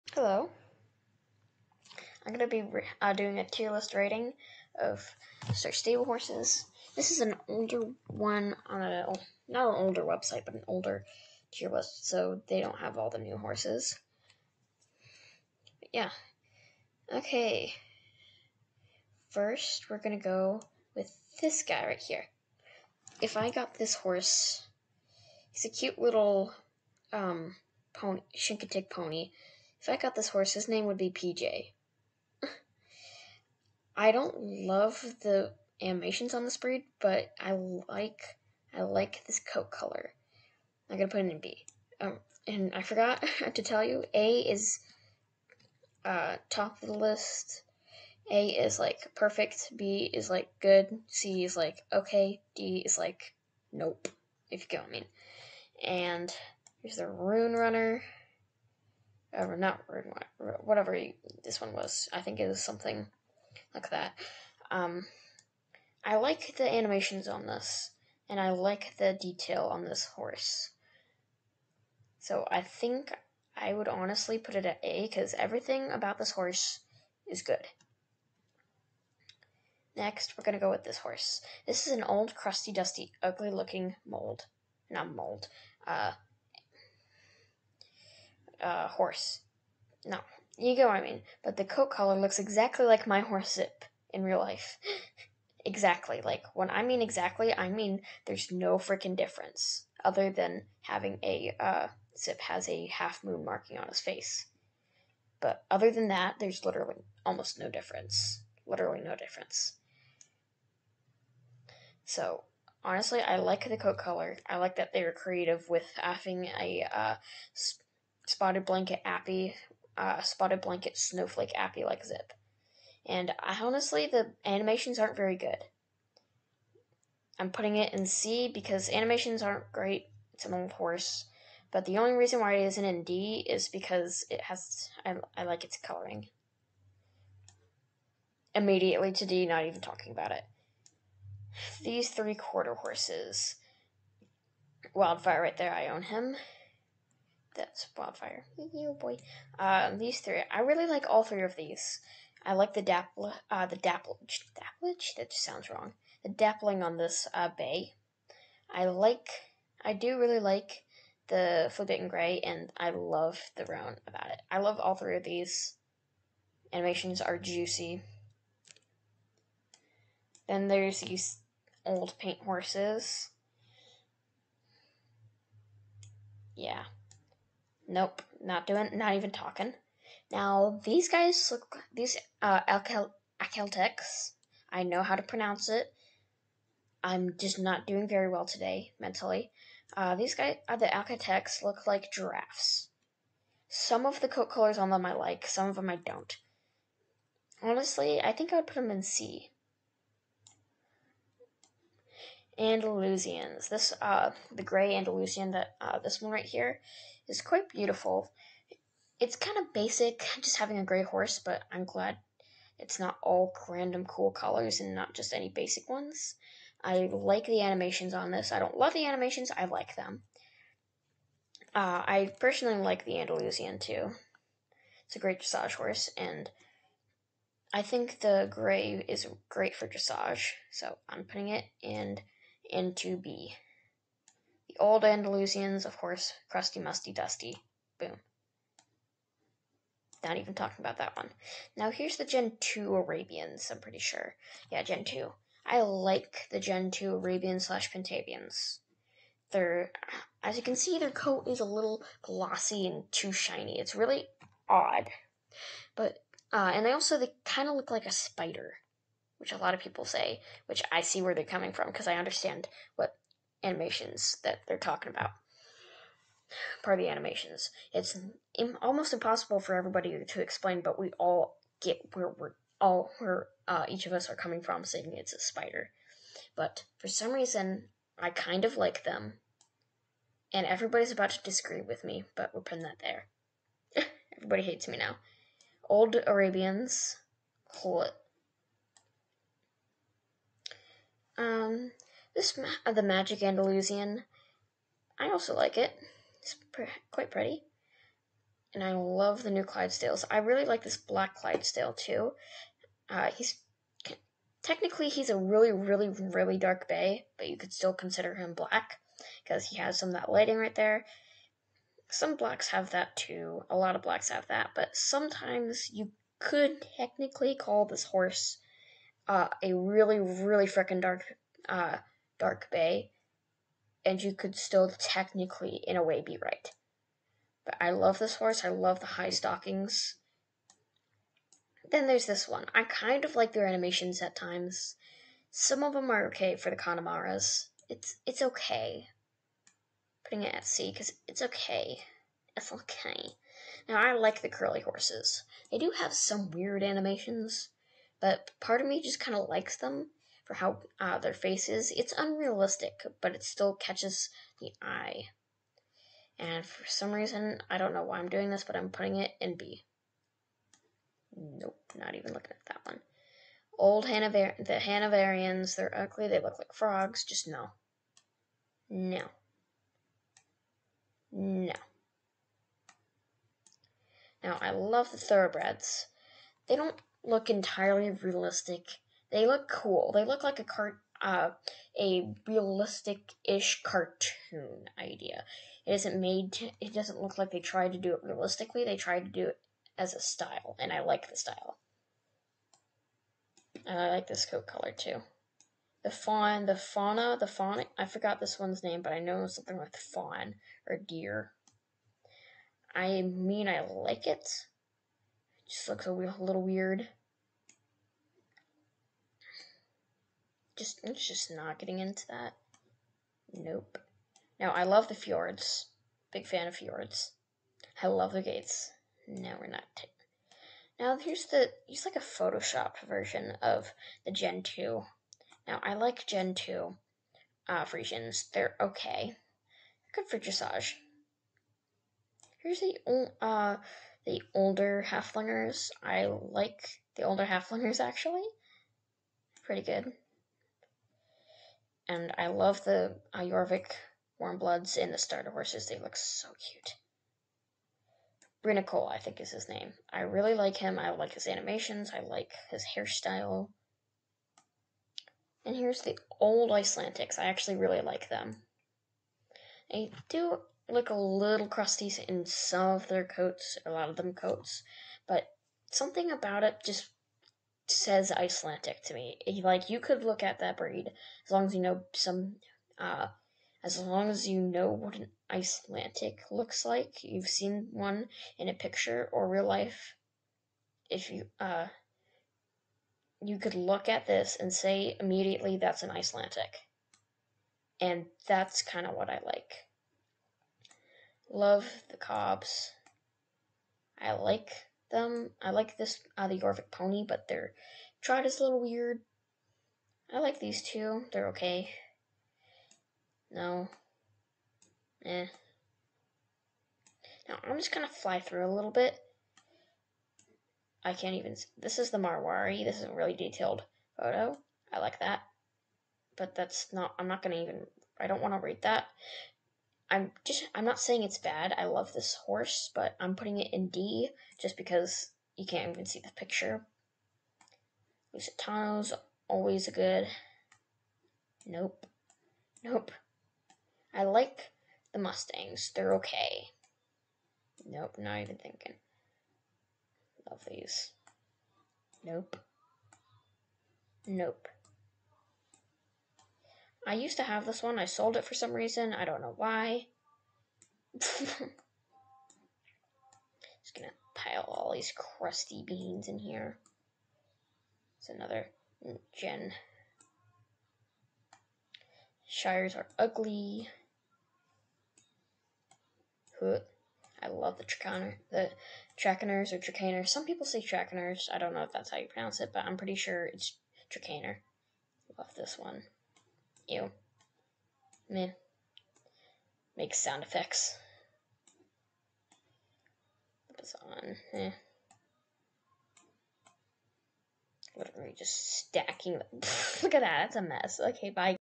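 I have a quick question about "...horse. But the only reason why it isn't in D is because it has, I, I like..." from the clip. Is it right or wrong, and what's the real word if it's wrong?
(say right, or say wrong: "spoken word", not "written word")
right.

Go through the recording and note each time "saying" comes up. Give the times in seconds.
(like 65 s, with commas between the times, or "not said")
274 s, 520 s.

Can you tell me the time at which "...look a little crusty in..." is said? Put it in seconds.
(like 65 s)
460 s.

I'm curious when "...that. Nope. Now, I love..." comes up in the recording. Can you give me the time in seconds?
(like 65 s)
412 s.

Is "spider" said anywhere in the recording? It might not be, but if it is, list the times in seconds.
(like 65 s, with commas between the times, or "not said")
258 s, 275 s.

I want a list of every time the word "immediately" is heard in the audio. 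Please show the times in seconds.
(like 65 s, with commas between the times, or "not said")
138 s, 485 s.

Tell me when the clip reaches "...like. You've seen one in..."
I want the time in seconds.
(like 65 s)
476 s.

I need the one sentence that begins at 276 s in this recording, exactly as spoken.
But for some reason, I kind of like them, and everybody's about to disagree with me, but we're putting that there.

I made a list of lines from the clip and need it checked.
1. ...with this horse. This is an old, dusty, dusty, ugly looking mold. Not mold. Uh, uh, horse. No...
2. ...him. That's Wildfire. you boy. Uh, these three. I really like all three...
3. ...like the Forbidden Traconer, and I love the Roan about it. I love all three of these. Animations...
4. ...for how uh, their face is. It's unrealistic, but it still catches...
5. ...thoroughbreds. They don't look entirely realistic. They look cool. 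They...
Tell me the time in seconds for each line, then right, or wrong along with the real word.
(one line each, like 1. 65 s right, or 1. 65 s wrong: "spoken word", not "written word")
1. 80 s wrong: "crusty", not "dusty"
2. 146 s right
3. 160 s wrong: "Gray", not "Traconer"
4. 350 s right
5. 375 s right.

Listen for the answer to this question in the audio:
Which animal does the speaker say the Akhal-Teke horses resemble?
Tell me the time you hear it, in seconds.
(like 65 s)
192 s.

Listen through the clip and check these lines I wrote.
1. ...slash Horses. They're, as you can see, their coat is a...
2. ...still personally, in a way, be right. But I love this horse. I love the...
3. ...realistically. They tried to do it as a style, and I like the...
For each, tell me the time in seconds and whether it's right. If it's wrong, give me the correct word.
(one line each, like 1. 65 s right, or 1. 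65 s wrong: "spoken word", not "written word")
1. 247 s wrong: "Pentavians", not "Horses"
2. 324 s wrong: "technically", not "personally"
3. 388 s right.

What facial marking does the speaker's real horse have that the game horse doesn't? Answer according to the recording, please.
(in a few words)
half moon marking.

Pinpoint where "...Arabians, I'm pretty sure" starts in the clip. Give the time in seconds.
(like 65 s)
242 s.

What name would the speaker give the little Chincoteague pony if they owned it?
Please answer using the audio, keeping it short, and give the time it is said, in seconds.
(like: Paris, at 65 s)
PJ, at 31 s.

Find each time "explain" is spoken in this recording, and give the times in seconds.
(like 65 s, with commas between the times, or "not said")
270 s.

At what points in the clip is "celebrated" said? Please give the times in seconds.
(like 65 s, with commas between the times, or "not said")
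not said.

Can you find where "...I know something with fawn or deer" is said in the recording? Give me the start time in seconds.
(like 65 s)
399 s.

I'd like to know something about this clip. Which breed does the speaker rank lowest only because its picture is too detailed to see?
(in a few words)
Marwari.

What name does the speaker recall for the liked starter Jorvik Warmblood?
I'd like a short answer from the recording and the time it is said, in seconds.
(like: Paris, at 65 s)
Brinacol, at 448 s.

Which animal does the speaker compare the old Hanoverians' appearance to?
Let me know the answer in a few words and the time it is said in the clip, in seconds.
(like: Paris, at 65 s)
frogs, at 366 s.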